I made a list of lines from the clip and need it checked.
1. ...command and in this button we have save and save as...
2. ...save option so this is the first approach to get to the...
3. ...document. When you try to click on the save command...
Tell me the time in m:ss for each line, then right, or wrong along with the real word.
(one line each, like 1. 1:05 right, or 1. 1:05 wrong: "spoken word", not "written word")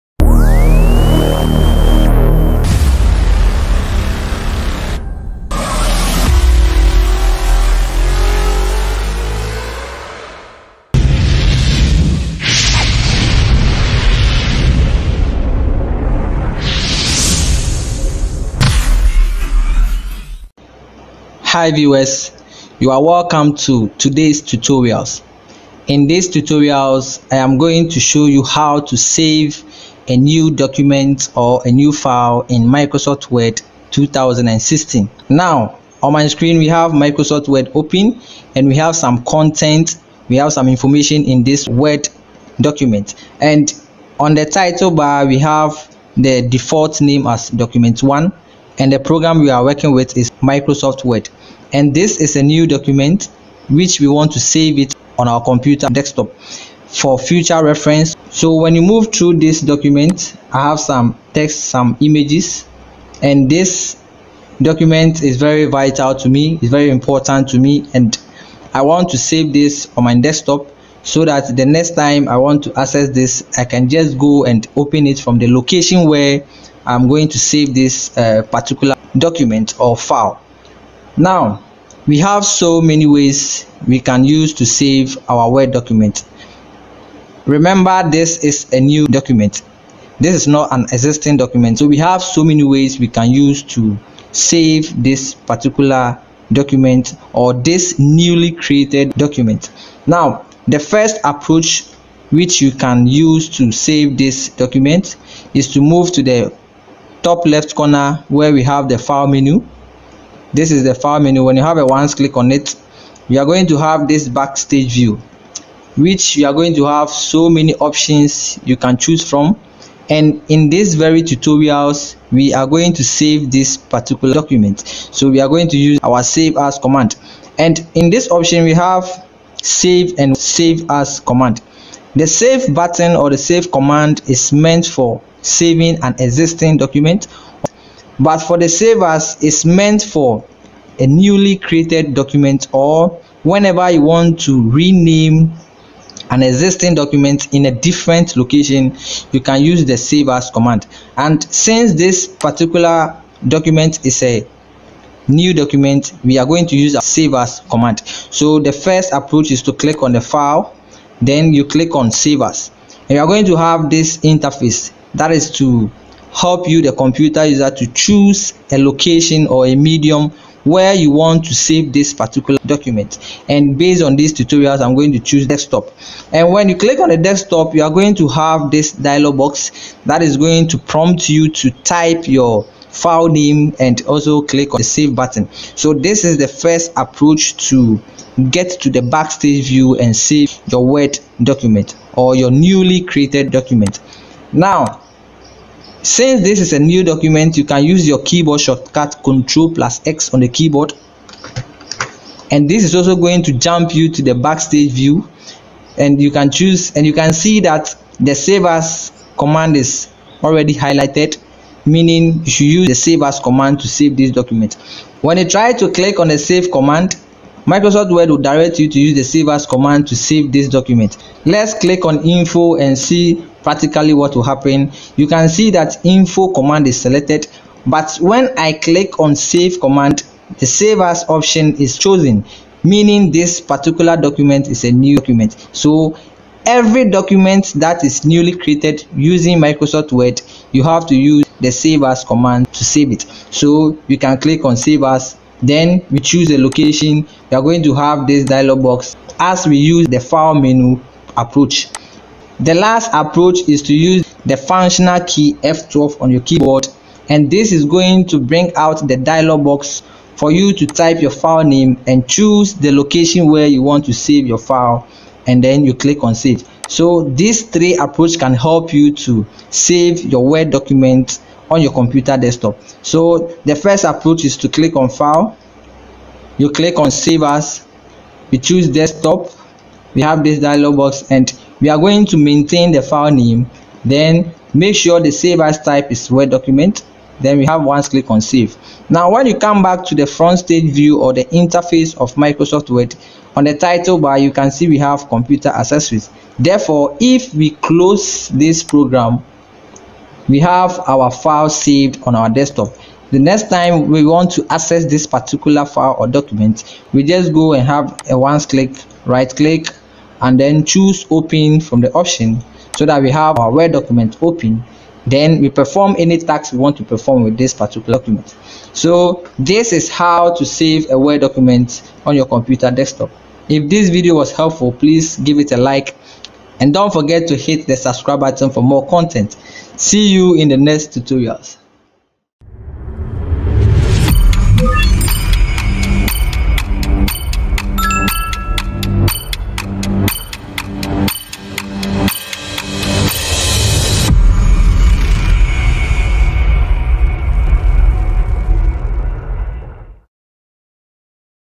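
1. 2:06 wrong: "option", not "button"
2. 3:04 wrong: "button", not "option"
3. 3:34 right.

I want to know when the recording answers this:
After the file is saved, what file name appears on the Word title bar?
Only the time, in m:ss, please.
4:55.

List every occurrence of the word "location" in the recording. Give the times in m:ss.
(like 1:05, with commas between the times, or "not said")
1:15, 2:28, 2:48, 4:06, 4:22.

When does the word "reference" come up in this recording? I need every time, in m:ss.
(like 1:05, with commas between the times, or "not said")
0:57.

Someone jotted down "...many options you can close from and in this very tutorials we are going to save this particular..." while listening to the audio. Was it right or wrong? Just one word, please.
wrong.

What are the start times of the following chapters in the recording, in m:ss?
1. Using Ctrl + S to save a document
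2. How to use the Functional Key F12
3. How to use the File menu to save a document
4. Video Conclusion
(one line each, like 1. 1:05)
1. 3:15
2. 4:13
3. 0:35
4. 4:33.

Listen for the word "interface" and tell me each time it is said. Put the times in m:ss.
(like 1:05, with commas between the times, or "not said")
2:44, 4:51.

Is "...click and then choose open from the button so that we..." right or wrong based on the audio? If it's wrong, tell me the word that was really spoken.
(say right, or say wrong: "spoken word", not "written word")
wrong: "option", not "button".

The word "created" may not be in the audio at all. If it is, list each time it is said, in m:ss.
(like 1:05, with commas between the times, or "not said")
1:38, 2:21, 3:13, 3:58.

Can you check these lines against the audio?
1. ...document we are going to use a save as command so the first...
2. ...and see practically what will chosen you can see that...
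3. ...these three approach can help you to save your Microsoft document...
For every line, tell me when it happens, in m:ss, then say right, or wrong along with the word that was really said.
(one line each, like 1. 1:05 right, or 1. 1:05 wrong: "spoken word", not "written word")
1. 2:35 right
2. 3:42 wrong: "happen", not "chosen"
3. 4:27 wrong: "Word", not "Microsoft".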